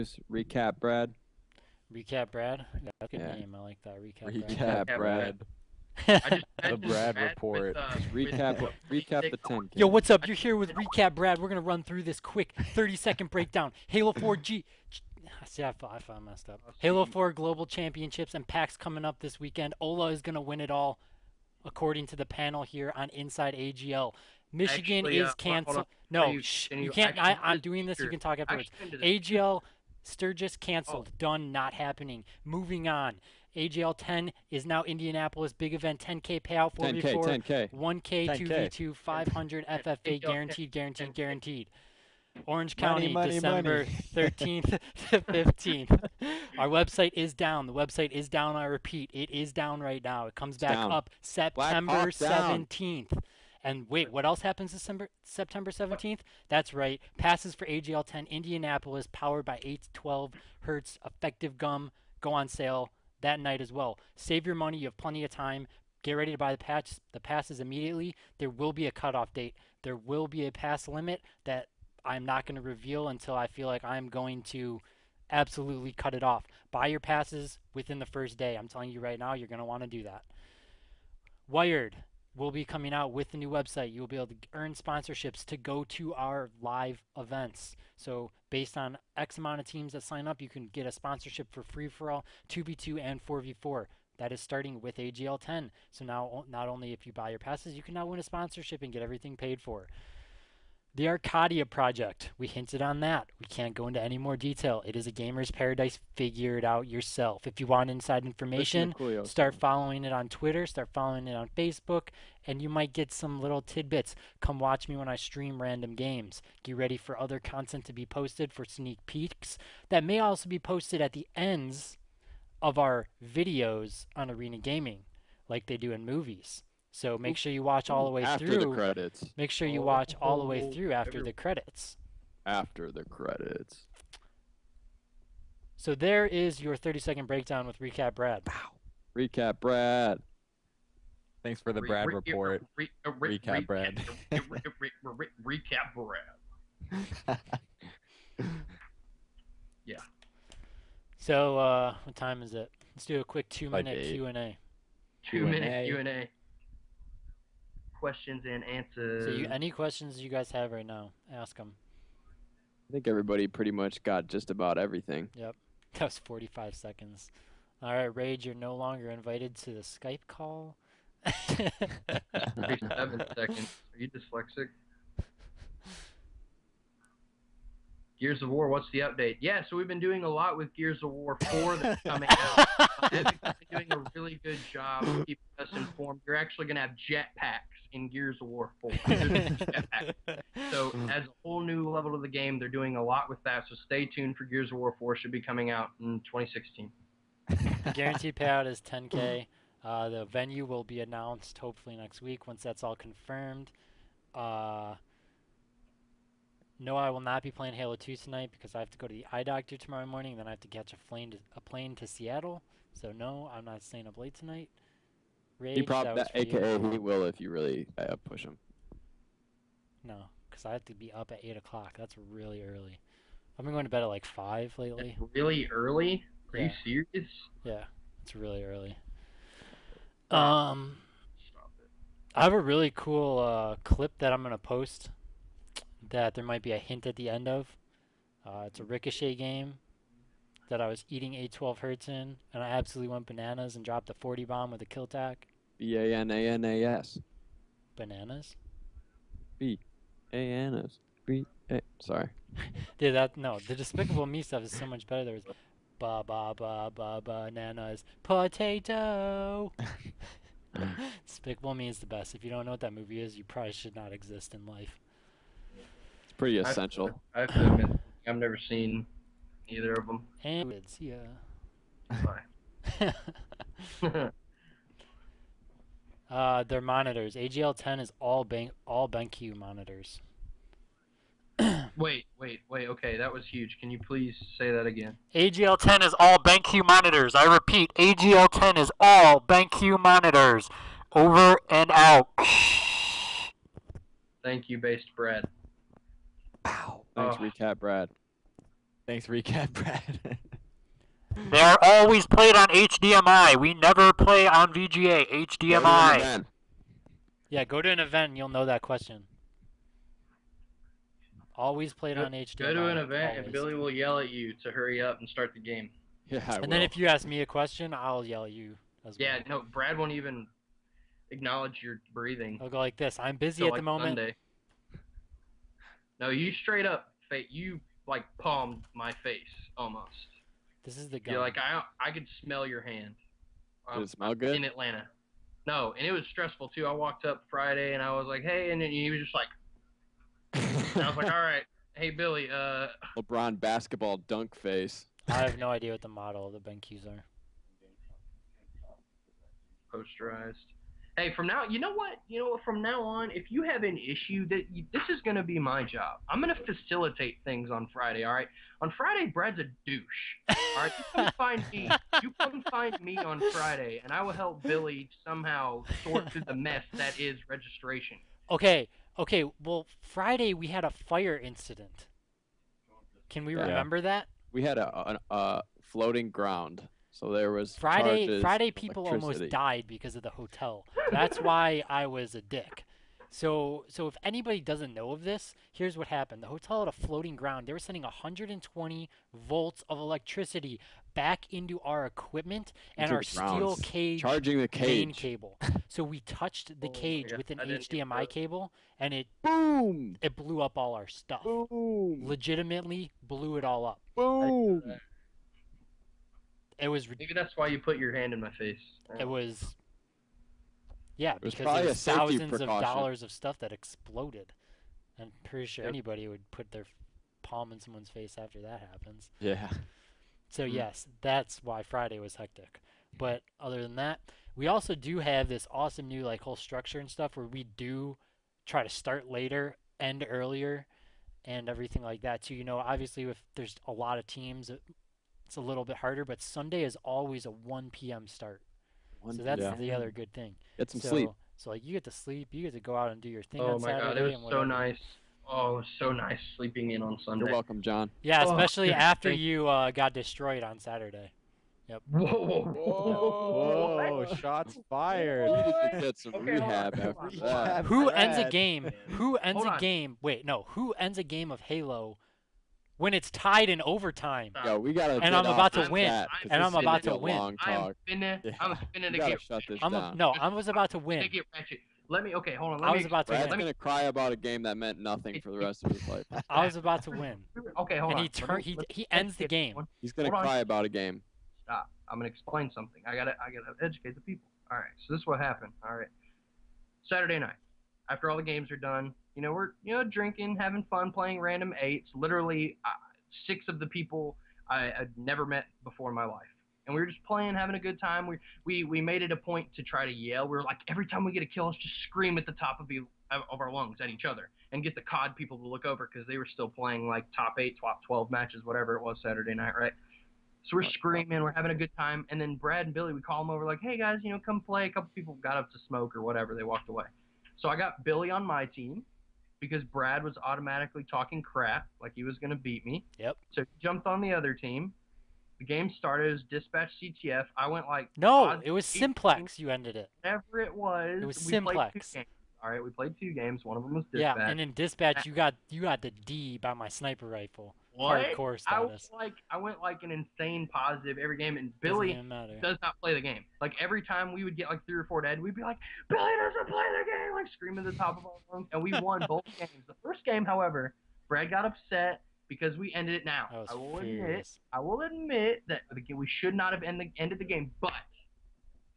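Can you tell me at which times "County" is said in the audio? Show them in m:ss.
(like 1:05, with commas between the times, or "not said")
0:42.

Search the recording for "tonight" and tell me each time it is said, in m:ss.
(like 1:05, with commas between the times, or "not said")
3:28, 3:34.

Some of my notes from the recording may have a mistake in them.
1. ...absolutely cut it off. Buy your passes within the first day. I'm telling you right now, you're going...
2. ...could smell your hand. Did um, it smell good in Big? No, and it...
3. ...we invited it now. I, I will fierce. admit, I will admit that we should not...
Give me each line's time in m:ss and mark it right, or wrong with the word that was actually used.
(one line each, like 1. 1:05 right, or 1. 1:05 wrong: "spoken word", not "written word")
1. 1:15 right
2. 5:32 wrong: "Atlanta", not "Big"
3. 9:12 wrong: "ended", not "invited".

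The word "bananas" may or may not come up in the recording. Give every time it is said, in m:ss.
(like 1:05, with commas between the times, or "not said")
4:03, 4:07, 4:17.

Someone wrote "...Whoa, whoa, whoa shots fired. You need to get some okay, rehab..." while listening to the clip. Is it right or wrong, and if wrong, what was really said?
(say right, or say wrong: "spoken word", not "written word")
right.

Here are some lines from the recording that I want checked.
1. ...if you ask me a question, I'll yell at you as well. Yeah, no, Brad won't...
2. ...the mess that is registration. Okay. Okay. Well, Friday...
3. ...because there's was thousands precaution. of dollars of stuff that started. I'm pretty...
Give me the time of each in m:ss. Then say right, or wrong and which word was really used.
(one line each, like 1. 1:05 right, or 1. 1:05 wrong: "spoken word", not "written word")
1. 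5:16 right
2. 6:06 right
3. 6:51 wrong: "exploded", not "started".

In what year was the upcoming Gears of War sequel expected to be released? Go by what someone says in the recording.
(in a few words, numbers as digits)
2016.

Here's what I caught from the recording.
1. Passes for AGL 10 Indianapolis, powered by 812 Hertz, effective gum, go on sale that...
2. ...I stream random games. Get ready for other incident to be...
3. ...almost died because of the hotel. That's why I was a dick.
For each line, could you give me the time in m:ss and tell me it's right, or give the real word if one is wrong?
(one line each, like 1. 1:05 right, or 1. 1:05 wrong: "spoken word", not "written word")
1. 0:57 right
2. 1:55 wrong: "content", not "incident"
3. 6:19 right.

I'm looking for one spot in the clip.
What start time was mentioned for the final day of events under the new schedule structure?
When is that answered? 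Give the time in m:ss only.
7:17.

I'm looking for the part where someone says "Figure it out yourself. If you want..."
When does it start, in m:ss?
1:46.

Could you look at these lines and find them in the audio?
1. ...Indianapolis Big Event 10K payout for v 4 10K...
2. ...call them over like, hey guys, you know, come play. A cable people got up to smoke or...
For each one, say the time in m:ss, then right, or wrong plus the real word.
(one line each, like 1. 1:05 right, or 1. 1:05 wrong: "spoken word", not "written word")
1. 0:34 right
2. 8:33 wrong: "couple", not "cable".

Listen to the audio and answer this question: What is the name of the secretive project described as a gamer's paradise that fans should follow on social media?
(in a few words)
The Arcadia Project.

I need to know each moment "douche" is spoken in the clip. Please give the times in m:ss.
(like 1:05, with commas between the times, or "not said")
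5:59.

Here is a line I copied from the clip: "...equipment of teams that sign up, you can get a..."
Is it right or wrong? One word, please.
wrong.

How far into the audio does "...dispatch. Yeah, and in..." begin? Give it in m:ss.
8:54.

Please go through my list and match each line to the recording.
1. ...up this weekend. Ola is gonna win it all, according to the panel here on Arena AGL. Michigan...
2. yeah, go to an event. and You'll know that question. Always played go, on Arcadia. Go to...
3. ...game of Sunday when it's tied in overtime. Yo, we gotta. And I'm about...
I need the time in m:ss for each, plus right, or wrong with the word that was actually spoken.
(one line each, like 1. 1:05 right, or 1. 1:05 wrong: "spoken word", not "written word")
1. 0:19 wrong: "Inside", not "Arena"
2. 5:07 wrong: "HDMI", not "Arcadia"
3. 7:41 wrong: "Halo", not "Sunday".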